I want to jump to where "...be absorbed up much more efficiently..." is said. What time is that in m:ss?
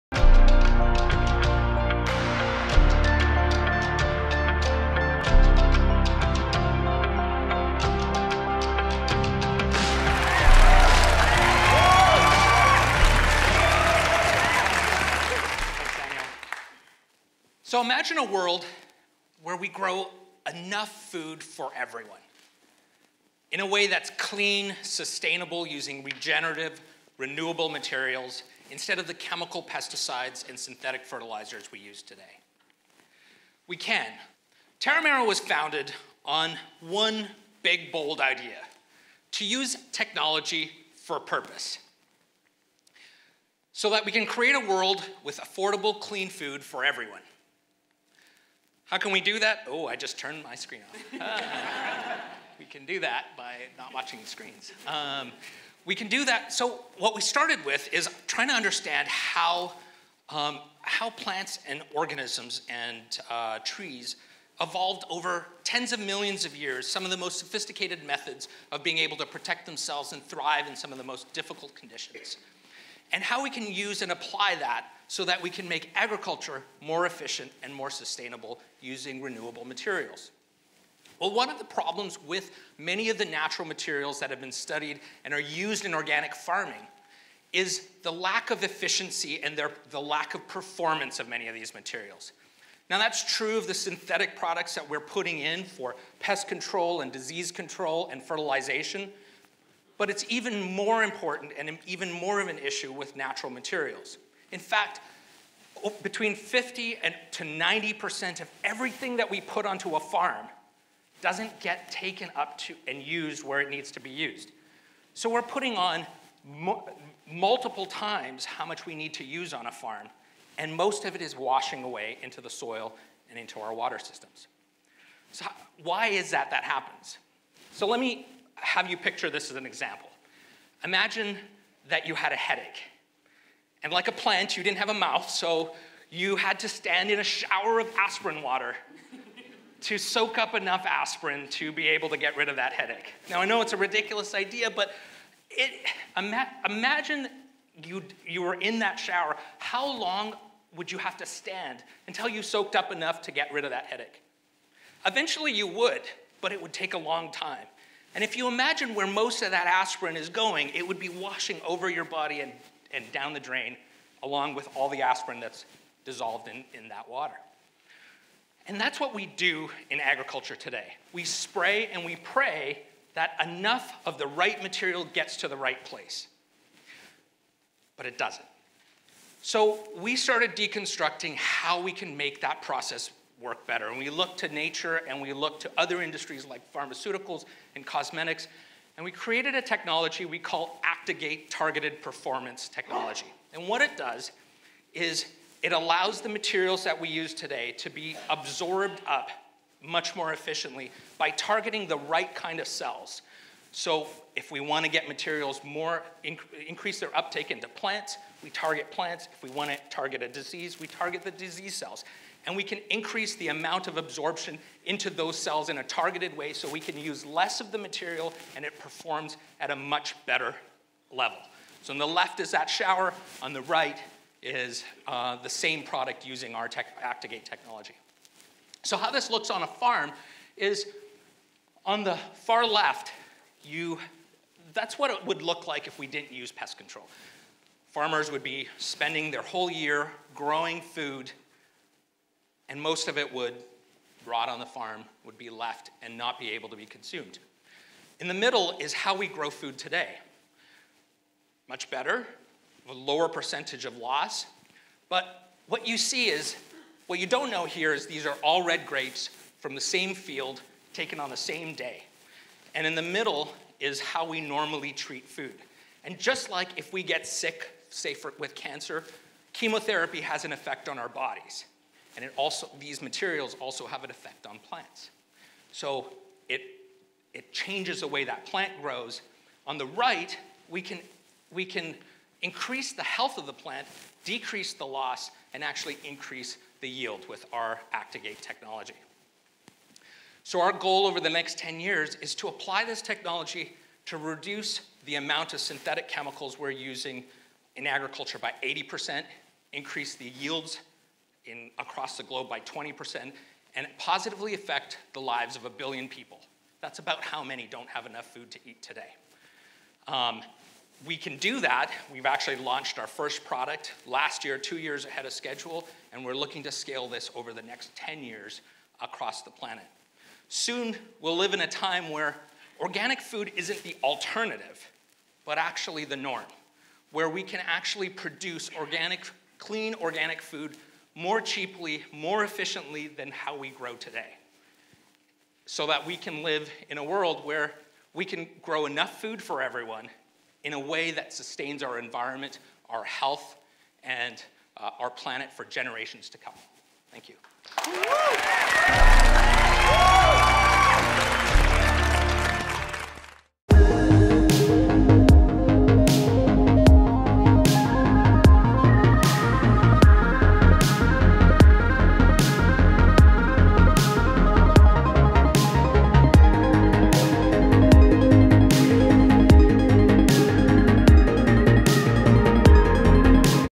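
3:17.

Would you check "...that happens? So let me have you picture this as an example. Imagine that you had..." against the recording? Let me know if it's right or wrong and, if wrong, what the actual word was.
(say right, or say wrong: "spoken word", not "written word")
right.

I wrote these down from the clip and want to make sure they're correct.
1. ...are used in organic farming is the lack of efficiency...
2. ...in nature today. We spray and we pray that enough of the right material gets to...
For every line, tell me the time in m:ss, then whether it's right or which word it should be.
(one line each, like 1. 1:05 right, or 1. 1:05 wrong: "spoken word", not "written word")
1. 1:25 right
2. 2:49 wrong: "agriculture", not "nature".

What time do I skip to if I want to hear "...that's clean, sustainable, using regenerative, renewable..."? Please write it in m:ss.
0:23.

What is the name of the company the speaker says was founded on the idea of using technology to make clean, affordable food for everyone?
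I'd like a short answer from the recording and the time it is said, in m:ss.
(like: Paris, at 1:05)
Terramera, at 0:34.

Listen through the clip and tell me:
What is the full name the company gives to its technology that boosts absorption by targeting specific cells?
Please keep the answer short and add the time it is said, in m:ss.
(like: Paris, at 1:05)
Actigate Targeted Performance Technology, at 3:10.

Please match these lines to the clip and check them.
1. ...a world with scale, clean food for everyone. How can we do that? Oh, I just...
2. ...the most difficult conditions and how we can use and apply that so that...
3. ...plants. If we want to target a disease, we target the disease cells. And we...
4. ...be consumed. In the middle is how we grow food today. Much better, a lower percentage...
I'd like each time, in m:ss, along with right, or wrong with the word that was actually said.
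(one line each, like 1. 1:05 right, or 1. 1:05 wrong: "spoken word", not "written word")
1. 0:44 wrong: "affordable", not "scale"
2. 1:10 right
3. 3:28 right
4. 4:06 right.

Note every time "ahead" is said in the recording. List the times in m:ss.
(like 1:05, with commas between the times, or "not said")
5:15.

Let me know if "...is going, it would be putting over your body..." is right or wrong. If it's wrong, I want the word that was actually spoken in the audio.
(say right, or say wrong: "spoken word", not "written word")
wrong: "washing", not "putting".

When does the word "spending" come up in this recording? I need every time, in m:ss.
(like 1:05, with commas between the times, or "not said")
3:58.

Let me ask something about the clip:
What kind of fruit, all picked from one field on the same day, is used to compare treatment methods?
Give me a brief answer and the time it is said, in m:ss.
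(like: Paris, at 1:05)
red grapes, at 4:18.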